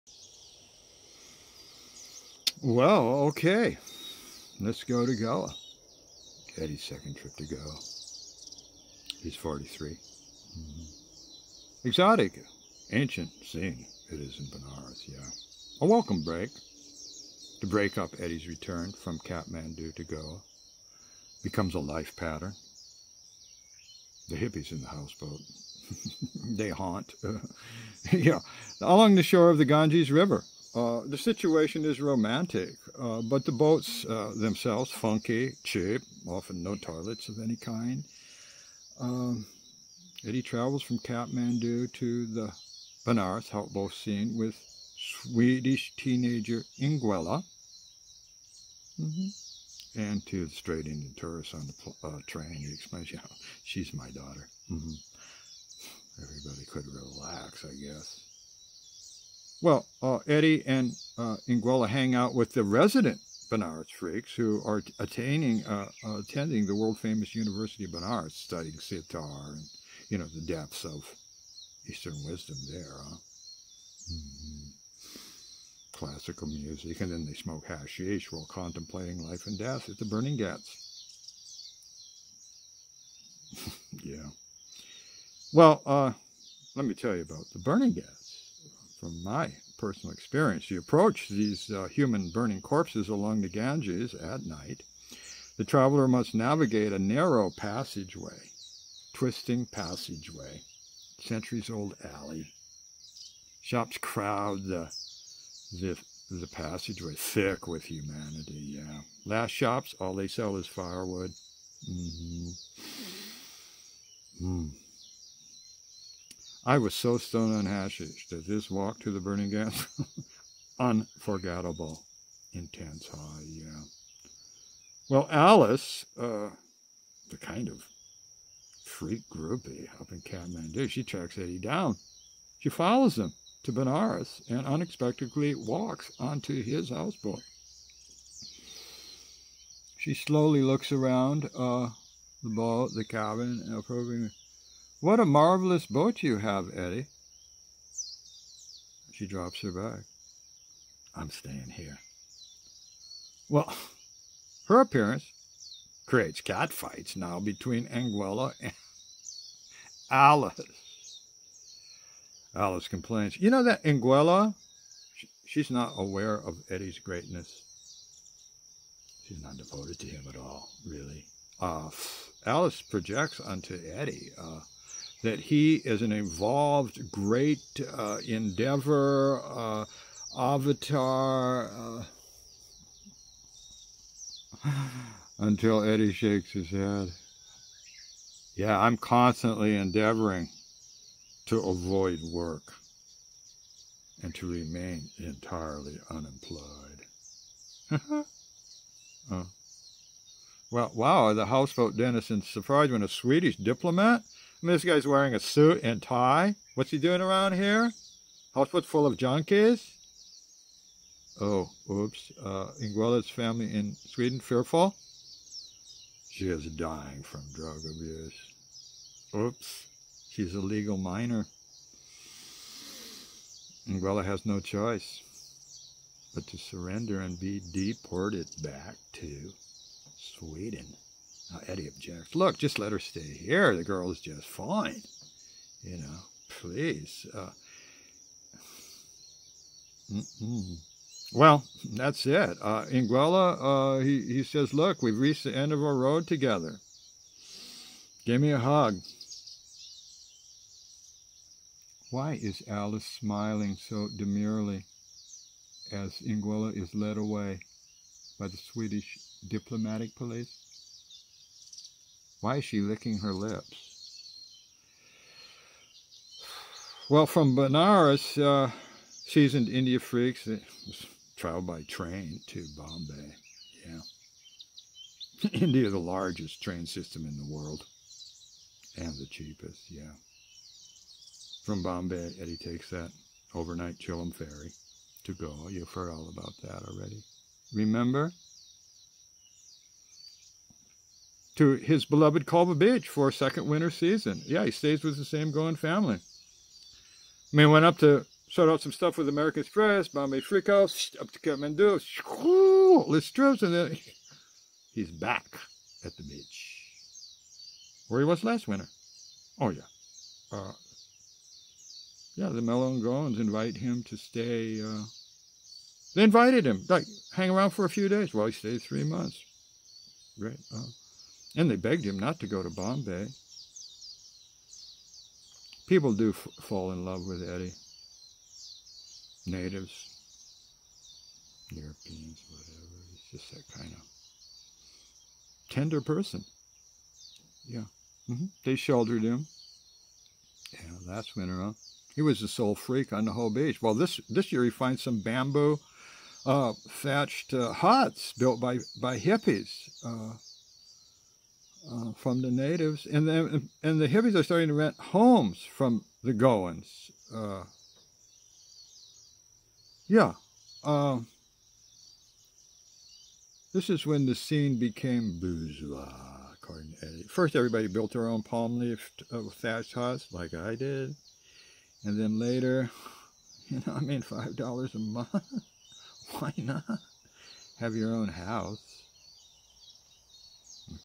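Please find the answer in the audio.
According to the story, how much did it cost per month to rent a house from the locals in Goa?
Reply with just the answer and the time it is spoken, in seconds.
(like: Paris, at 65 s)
$5, at 374 s.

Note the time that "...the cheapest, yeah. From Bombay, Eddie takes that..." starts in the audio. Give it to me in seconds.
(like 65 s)
279 s.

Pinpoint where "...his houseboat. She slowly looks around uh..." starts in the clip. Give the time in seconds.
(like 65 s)
136 s.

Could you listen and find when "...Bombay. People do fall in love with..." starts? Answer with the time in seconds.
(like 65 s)
322 s.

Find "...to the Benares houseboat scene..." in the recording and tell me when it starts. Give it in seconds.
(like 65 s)
41 s.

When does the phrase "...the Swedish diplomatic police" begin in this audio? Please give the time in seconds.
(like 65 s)
258 s.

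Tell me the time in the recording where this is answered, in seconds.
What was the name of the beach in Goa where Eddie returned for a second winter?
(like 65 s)
292 s.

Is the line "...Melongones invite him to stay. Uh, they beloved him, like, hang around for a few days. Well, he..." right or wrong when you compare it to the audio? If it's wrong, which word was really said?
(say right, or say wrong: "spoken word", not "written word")
wrong: "invited", not "beloved".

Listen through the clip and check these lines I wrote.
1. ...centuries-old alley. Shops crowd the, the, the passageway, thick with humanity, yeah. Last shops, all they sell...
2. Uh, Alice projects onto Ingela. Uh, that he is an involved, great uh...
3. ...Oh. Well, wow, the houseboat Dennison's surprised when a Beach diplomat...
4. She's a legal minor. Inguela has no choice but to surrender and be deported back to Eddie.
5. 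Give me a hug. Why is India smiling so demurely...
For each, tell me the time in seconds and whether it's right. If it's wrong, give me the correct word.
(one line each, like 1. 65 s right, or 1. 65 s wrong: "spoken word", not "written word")
1. 101 s right
2. 171 s wrong: "Eddie", not "Ingela"
3. 199 s wrong: "Swedish", not "Beach"
4. 220 s wrong: "Sweden", not "Eddie"
5. 248 s wrong: "Alice", not "India".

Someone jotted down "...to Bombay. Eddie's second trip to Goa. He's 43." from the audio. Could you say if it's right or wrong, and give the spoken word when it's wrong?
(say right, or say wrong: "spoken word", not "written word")
wrong: "Gala", not "Bombay".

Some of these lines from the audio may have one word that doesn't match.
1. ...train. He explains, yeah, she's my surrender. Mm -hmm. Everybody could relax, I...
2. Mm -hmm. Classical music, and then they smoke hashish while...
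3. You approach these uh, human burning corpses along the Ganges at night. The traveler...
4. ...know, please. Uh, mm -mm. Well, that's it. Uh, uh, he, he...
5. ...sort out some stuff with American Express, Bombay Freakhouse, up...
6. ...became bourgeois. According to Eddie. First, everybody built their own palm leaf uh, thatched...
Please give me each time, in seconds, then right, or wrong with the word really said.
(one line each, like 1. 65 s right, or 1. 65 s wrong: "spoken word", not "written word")
1. 52 s wrong: "daughter", not "surrender"
2. 74 s right
3. 90 s right
4. 235 s right
5. 298 s right
6. 364 s right.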